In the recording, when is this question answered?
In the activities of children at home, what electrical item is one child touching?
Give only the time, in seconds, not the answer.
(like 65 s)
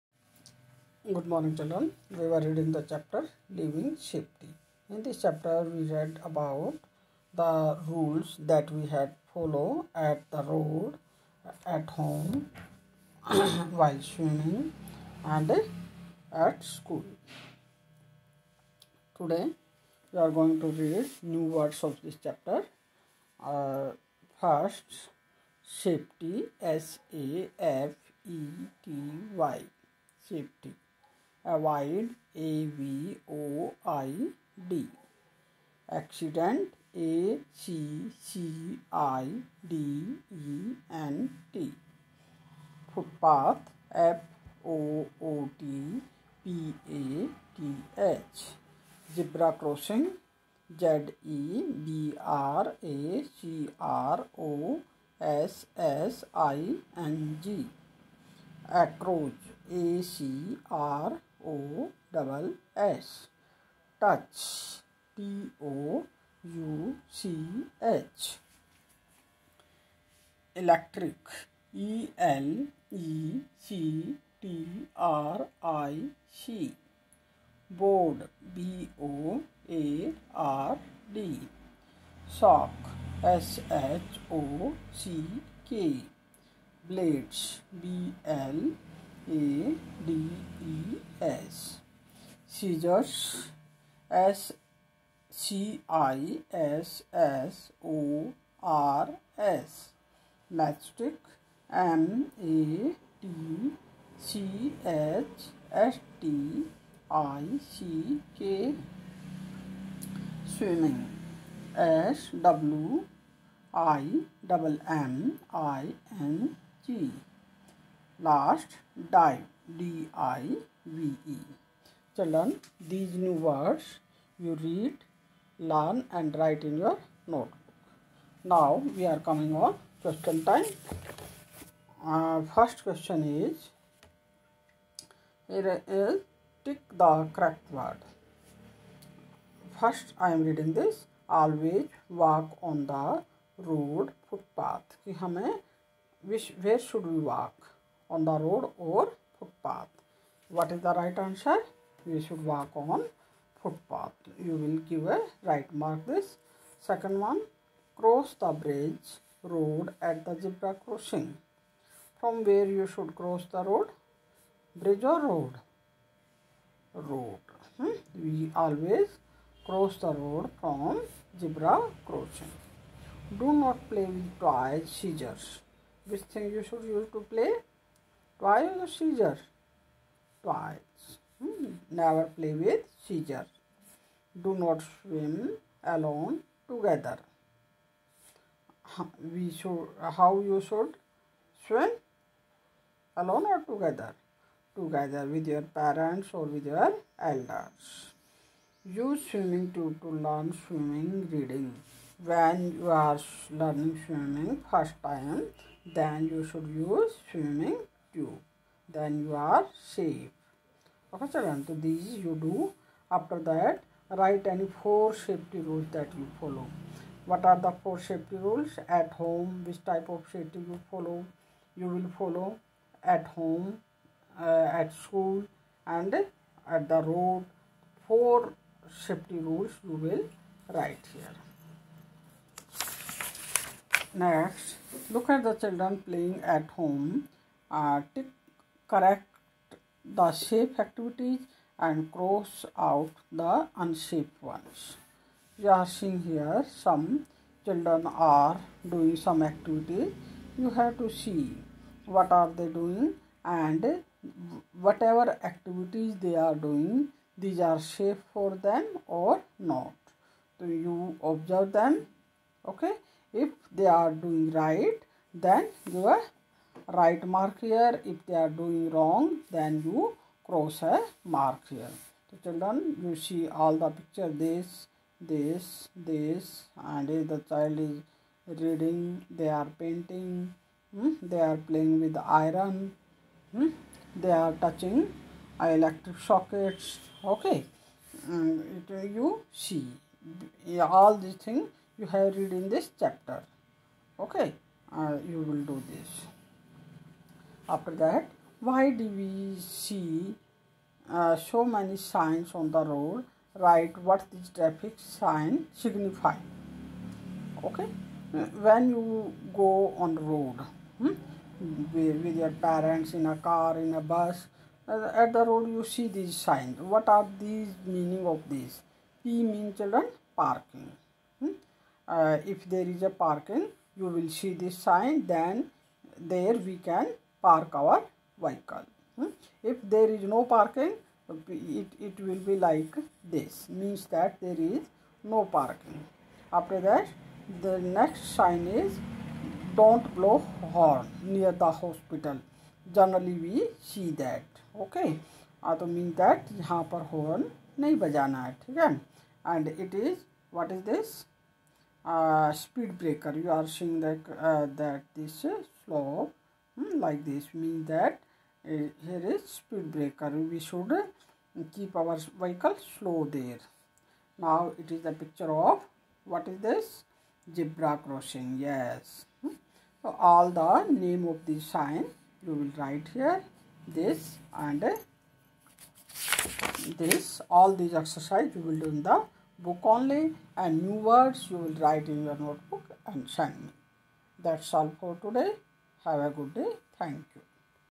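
285 s.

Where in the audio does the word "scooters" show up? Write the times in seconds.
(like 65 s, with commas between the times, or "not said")
not said.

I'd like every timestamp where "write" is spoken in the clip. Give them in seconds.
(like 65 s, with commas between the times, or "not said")
214 s, 230 s, 303 s, 372 s, 381 s.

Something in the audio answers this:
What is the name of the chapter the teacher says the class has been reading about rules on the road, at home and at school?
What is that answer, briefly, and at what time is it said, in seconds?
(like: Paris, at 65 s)
Living Safety, at 3 s.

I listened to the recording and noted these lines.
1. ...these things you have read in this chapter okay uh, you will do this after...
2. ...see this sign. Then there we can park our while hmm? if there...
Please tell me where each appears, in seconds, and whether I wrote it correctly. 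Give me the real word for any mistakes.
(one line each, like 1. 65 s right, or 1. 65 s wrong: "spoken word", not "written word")
1. 291 s right
2. 324 s wrong: "vehicle", not "while".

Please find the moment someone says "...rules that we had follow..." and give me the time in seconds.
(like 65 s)
7 s.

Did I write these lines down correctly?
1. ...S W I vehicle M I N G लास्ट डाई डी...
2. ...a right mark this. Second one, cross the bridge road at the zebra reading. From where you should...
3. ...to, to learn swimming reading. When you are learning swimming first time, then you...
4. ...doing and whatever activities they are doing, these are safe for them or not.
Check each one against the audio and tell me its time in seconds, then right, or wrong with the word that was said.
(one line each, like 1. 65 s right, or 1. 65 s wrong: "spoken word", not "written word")
1. 111 s wrong: "double", not "vehicle"
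2. 155 s wrong: "crossing", not "reading"
3. 199 s right
4. 252 s right.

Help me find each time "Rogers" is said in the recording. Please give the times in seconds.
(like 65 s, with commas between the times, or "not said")
not said.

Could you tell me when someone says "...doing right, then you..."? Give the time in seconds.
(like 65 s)
264 s.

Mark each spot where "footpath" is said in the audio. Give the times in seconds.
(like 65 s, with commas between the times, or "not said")
149 s, 153 s.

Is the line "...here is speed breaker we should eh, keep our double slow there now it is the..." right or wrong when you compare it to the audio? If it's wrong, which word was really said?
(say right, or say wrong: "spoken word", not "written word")
wrong: "vehicle", not "double".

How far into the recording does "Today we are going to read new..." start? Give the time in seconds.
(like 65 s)
19 s.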